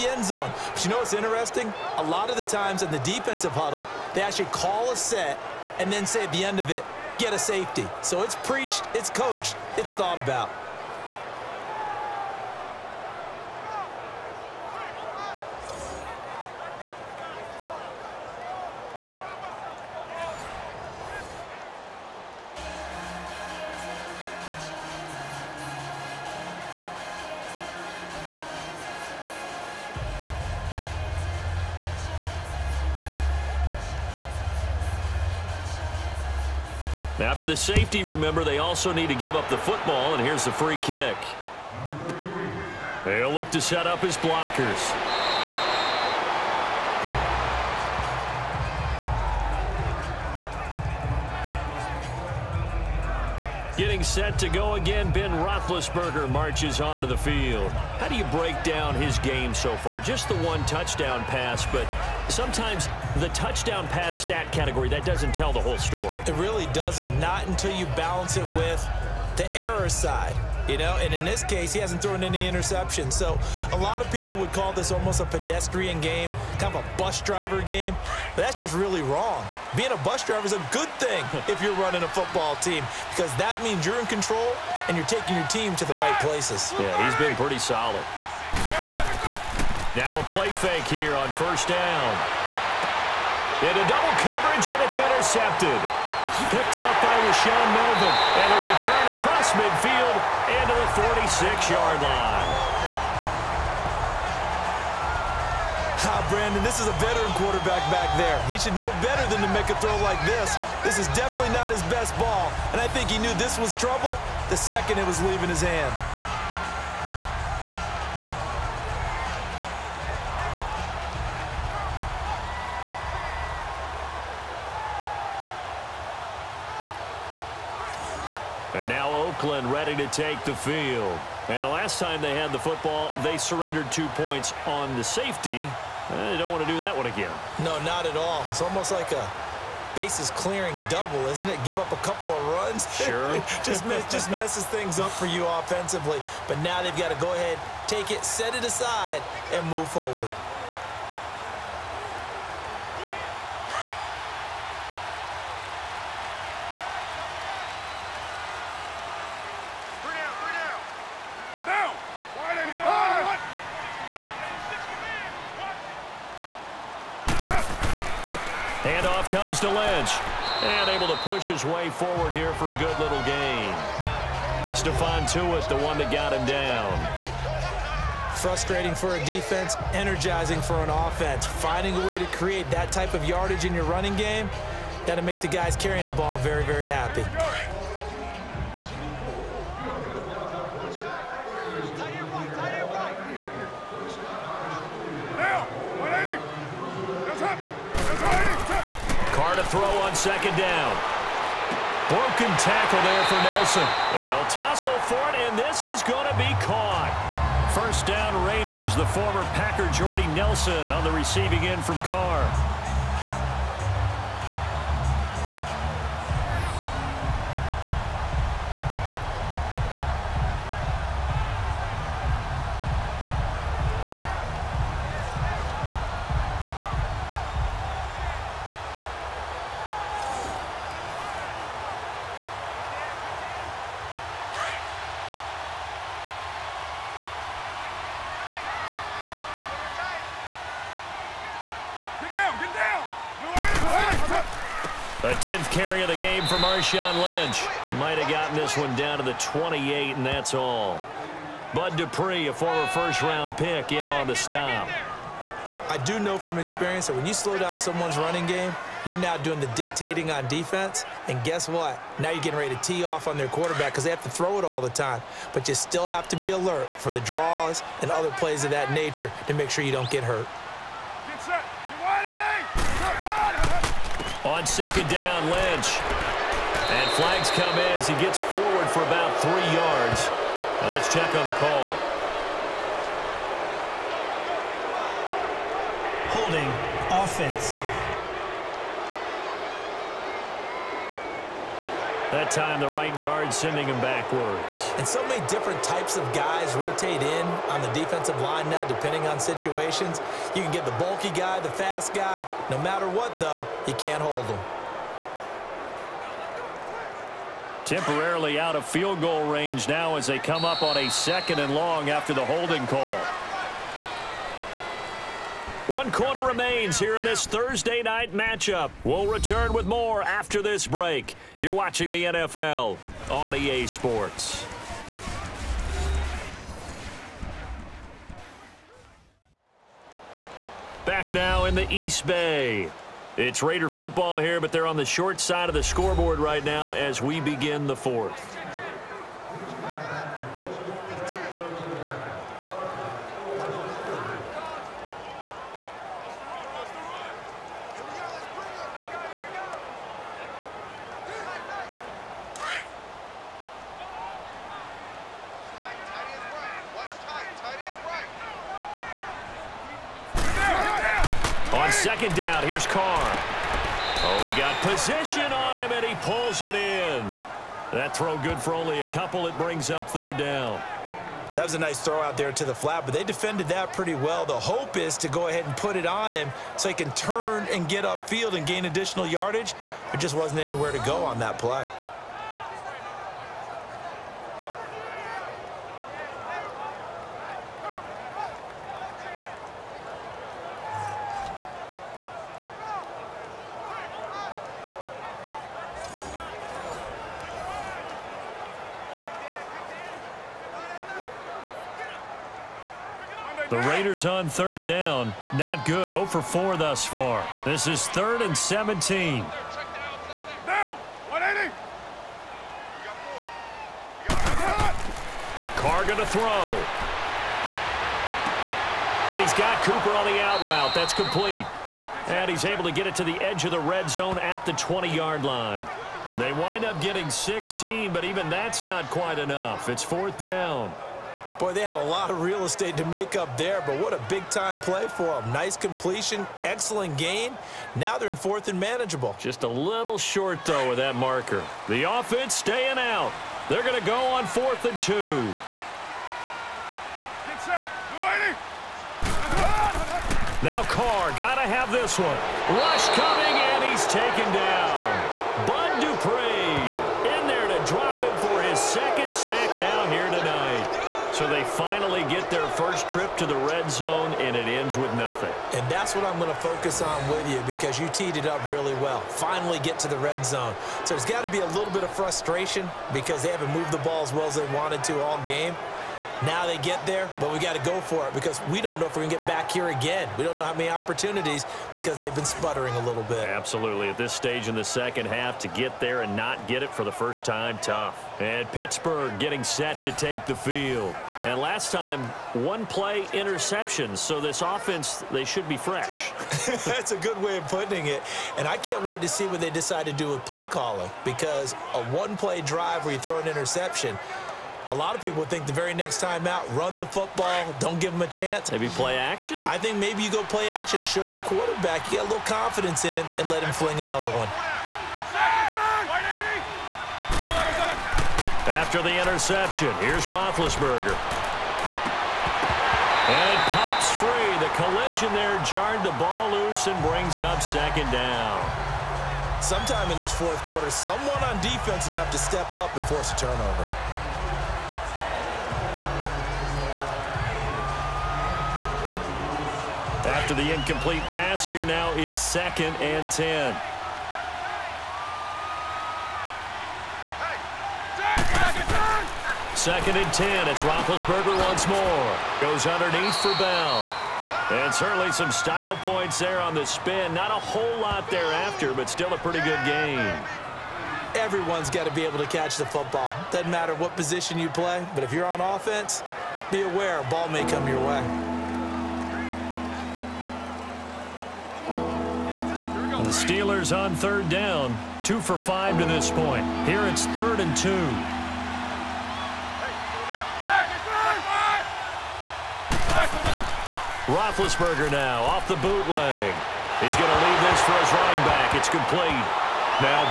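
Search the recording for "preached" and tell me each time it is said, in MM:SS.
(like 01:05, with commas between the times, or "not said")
00:08.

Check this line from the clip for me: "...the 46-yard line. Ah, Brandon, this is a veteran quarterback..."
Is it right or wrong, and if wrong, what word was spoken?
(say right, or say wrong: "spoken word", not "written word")
right.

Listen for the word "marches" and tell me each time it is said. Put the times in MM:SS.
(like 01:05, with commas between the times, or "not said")
00:56.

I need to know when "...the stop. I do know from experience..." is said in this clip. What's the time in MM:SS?
04:14.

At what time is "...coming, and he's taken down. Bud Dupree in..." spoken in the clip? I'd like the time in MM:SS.
07:33.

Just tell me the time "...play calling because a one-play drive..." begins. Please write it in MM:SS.
08:20.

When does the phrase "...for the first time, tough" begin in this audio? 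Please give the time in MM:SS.
08:06.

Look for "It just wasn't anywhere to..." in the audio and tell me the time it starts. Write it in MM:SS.
06:20.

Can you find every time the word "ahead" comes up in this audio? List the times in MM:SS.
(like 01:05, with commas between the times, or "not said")
02:27, 06:15.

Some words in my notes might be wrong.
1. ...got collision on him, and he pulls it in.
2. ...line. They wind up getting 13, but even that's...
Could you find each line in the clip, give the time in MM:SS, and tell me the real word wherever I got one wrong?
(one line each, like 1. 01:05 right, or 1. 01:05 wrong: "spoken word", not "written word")
1. 06:04 wrong: "position", not "collision"
2. 07:05 wrong: "16", not "13".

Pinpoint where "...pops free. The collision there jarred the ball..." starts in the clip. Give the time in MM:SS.
08:43.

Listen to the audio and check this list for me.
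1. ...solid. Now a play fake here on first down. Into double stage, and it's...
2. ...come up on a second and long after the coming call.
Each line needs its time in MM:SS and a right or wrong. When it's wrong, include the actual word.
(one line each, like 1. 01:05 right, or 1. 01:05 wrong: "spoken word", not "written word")
1. 01:27 wrong: "coverage", not "stage"
2. 05:10 wrong: "holding", not "coming".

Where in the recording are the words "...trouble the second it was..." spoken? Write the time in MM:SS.
01:53.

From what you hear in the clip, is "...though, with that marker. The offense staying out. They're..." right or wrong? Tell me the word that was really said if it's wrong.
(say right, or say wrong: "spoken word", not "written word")
right.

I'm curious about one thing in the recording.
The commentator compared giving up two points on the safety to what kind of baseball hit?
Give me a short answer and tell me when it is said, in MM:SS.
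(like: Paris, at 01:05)
bases clearing double, at 02:19.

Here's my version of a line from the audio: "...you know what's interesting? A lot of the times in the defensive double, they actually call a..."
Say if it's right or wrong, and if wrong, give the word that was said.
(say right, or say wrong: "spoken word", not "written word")
wrong: "huddle", not "double".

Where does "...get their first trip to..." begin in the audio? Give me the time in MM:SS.
07:42.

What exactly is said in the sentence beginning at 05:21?
You're watching the NFL on EA Sports.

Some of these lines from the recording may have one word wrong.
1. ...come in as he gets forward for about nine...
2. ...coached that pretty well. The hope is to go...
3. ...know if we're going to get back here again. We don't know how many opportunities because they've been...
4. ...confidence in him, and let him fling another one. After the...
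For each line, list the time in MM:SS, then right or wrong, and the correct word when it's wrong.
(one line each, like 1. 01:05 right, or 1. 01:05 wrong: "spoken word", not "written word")
1. 04:37 wrong: "three", not "nine"
2. 06:13 wrong: "defended", not "coached"
3. 07:58 right
4. 08:32 right.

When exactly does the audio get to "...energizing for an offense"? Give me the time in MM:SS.
02:59.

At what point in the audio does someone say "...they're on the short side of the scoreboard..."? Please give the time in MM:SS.
05:34.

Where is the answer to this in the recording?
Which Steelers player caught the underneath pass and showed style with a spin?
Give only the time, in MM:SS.
09:13.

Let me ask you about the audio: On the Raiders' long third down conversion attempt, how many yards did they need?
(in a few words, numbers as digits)
17.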